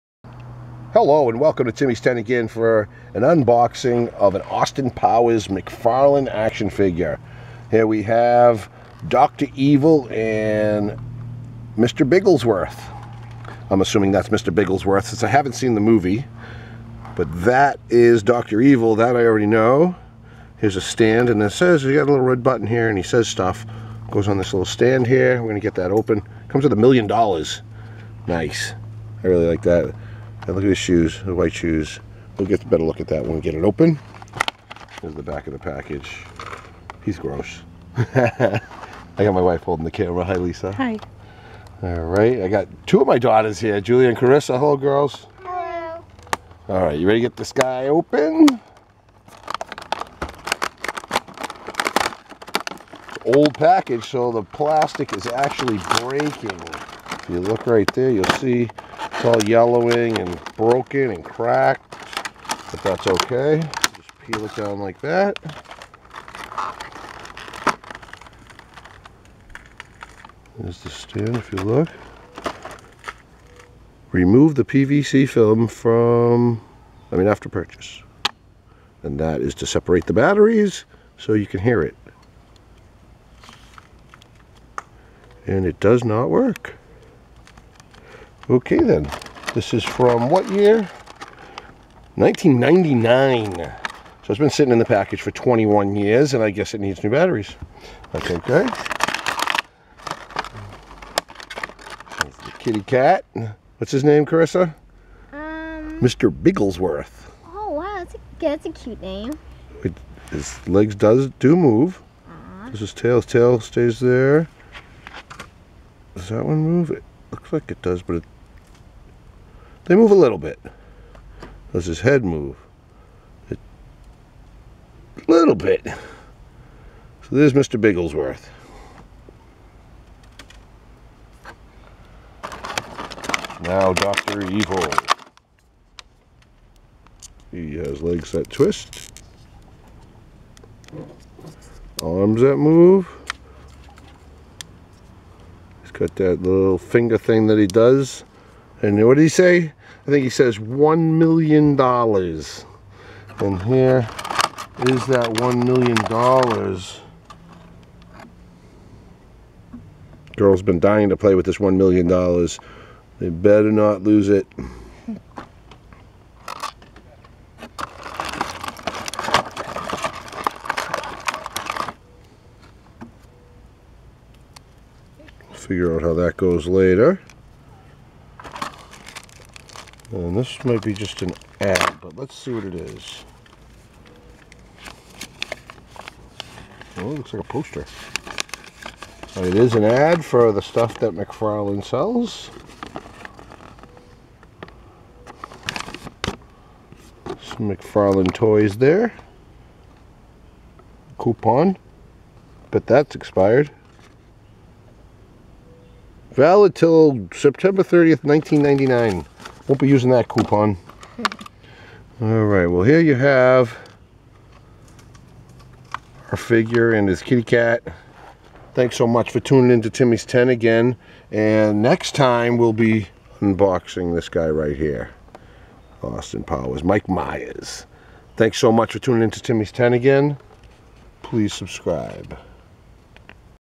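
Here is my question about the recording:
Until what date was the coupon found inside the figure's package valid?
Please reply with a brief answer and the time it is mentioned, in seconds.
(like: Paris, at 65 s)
September 30th, 1999, at 207 s.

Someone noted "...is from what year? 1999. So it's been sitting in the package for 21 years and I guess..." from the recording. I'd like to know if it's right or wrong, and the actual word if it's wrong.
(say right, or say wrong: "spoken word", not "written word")
right.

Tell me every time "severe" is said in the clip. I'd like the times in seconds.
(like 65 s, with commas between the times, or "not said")
not said.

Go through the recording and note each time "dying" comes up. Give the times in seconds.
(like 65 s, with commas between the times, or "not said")
160 s.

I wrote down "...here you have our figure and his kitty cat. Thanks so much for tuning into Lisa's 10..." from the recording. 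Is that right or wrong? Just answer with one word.
wrong.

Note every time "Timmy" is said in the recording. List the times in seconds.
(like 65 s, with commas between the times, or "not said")
1 s, 219 s, 229 s.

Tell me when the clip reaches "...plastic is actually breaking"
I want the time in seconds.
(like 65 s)
54 s.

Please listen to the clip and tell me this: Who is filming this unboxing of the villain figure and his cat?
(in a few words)
Lisa.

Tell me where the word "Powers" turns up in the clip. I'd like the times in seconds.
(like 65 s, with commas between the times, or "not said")
4 s, 226 s.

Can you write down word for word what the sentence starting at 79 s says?
And that is to separate the batteries so you can hear it.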